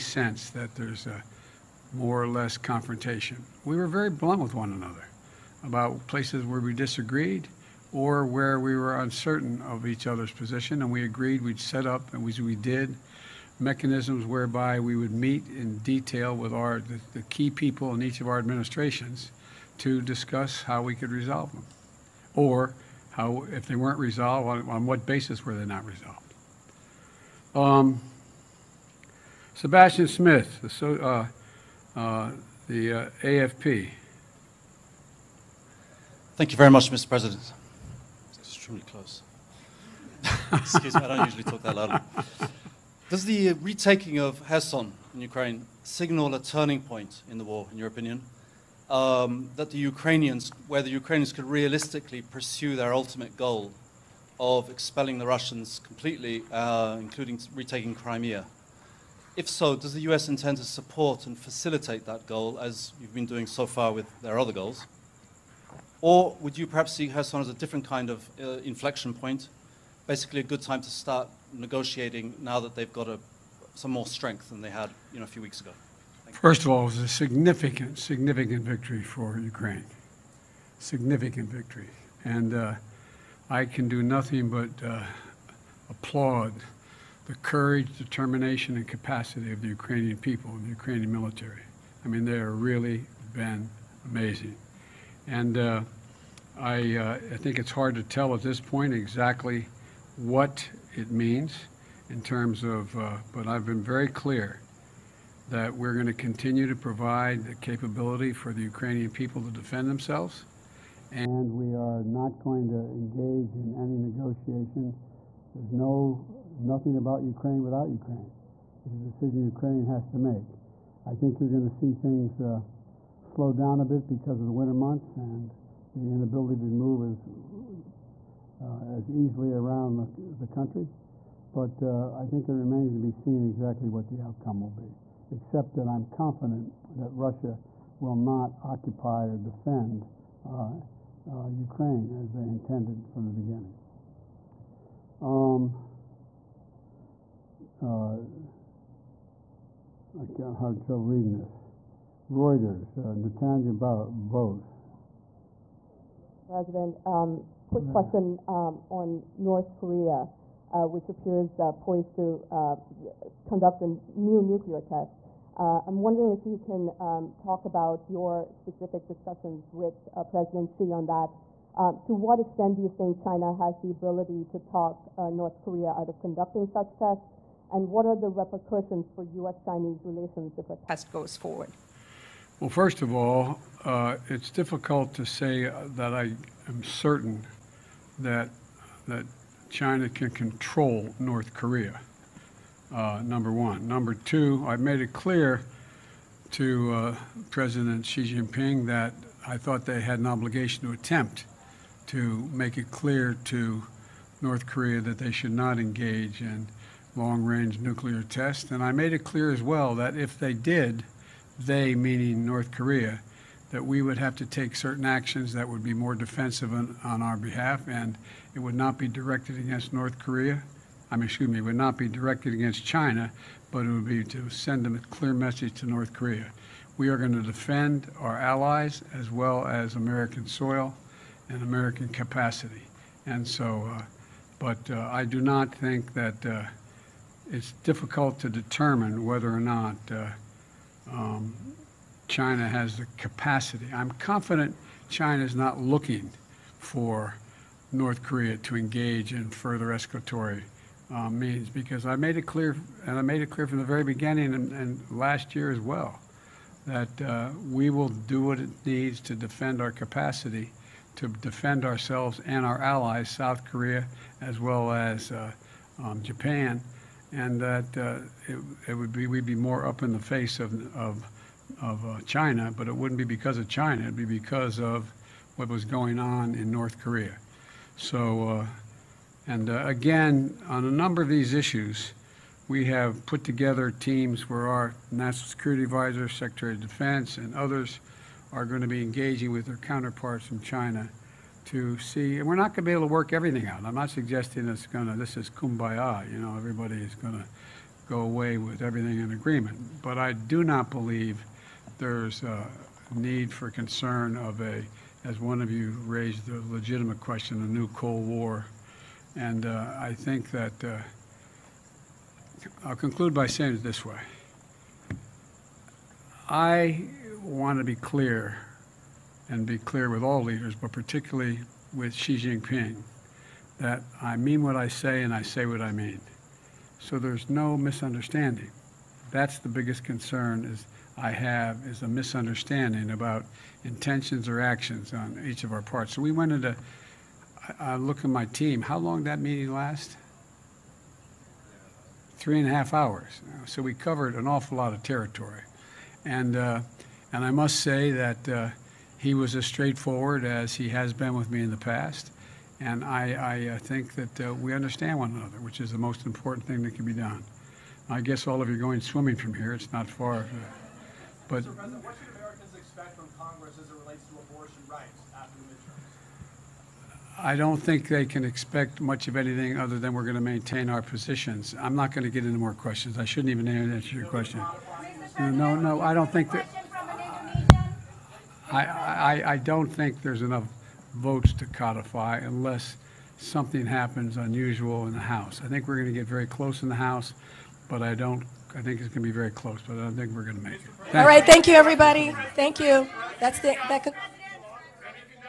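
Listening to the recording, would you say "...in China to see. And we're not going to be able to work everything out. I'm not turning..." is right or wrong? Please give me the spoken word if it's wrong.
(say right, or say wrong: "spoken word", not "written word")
wrong: "suggesting", not "turning".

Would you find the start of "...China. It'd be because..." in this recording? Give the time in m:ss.
4:33.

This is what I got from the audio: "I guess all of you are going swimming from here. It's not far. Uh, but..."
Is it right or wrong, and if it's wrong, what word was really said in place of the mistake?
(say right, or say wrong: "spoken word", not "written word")
right.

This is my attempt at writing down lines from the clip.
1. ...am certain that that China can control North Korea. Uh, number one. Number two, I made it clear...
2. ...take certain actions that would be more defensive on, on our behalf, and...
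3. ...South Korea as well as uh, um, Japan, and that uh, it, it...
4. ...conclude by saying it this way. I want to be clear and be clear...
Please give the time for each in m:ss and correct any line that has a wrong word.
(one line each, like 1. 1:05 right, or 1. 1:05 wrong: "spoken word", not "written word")
1. 3:06 right
2. 3:34 right
3. 4:23 right
4. 5:12 right.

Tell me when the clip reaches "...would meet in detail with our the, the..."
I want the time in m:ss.
0:14.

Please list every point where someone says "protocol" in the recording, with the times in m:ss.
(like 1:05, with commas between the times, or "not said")
not said.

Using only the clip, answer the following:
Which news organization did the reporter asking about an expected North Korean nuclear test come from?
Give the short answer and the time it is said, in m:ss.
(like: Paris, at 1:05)
Reuters, at 2:32.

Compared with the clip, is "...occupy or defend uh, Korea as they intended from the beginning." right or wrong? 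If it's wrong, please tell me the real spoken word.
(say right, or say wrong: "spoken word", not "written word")
wrong: "Ukraine", not "Korea".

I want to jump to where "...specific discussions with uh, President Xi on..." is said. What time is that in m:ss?
2:48.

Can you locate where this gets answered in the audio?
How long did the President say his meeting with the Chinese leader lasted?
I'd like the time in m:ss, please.
5:42.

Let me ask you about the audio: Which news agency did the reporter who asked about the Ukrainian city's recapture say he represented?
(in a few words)
AFP.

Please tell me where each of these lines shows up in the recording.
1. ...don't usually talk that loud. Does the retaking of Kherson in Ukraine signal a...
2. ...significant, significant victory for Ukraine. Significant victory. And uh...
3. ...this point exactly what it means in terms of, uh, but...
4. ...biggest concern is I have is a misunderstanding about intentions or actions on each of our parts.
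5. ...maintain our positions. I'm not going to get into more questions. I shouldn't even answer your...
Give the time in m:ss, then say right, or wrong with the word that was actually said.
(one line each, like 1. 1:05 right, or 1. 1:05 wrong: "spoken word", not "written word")
1. 0:41 right
2. 1:17 right
3. 1:38 right
4. 5:29 right
5. 6:10 right.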